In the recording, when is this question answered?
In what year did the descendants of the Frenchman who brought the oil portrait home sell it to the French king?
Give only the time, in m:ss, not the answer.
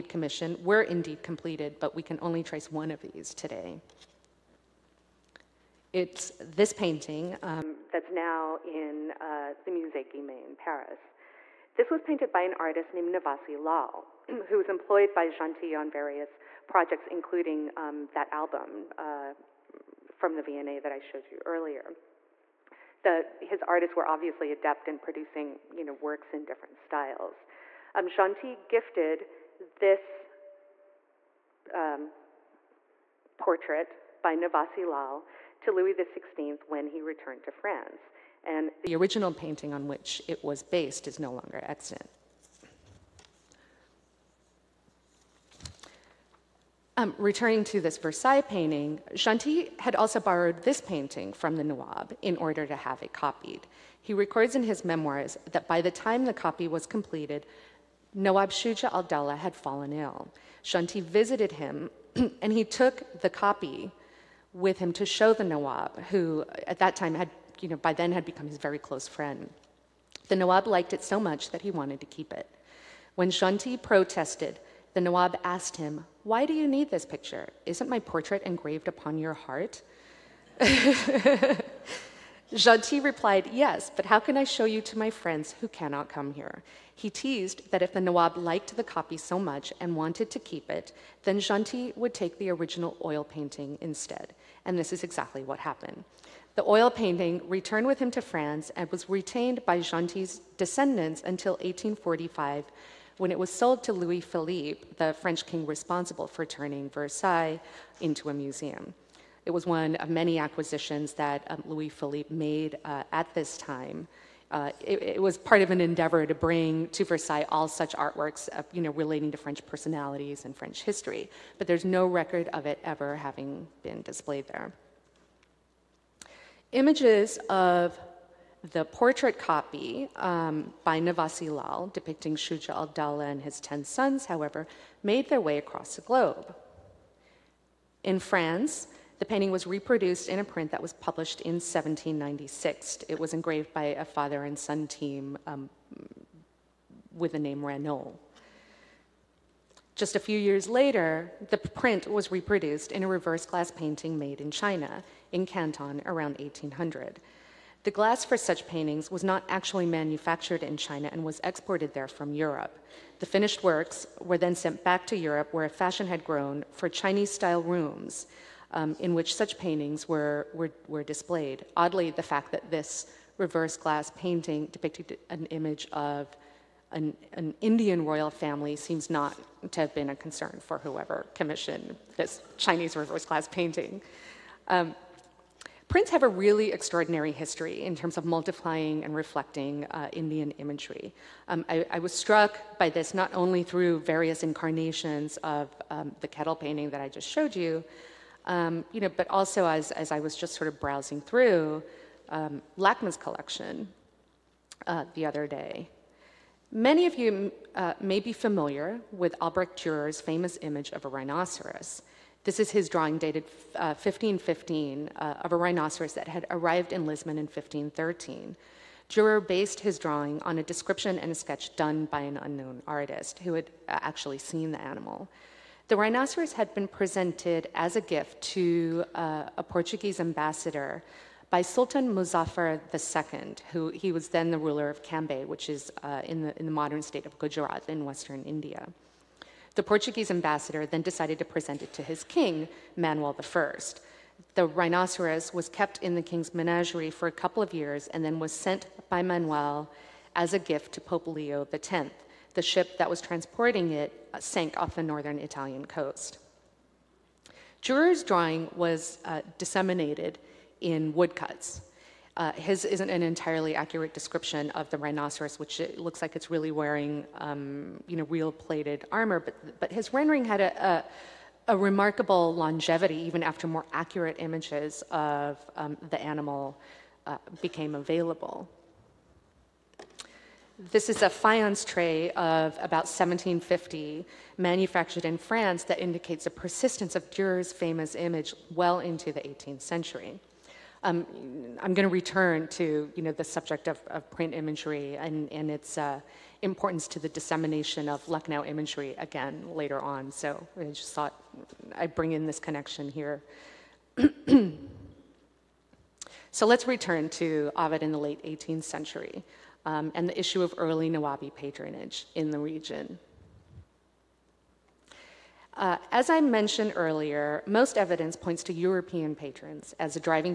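1:41.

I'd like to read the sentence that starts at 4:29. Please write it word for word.
But but his rendering had a, a, a remarkable longevity, even after more accurate images of um, the animal uh, became available.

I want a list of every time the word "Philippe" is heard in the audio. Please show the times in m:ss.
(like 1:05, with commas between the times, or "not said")
1:44, 1:51.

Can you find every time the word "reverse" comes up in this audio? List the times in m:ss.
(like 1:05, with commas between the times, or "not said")
2:33, 2:53, 3:02.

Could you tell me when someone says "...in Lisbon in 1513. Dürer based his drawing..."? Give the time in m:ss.
3:36.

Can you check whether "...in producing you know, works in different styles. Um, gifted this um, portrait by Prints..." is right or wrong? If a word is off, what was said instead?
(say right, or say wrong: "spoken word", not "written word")
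wrong: "Navasi", not "Prints".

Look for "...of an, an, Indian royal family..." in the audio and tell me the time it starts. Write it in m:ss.
2:55.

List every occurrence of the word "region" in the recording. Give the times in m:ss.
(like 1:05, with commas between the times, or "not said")
5:12.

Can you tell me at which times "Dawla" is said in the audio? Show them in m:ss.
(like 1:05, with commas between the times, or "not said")
0:58, 2:12.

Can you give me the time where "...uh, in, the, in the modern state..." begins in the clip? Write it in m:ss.
3:56.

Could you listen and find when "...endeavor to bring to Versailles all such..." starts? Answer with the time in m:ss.
1:55.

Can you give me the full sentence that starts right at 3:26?
Many of you uh, may be familiar with Albrecht Dürer's famous image of a rhinoceros.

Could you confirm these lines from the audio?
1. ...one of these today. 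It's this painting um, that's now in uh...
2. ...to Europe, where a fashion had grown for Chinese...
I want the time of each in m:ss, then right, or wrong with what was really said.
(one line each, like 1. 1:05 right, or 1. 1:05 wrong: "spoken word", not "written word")
1. 0:02 right
2. 2:45 right.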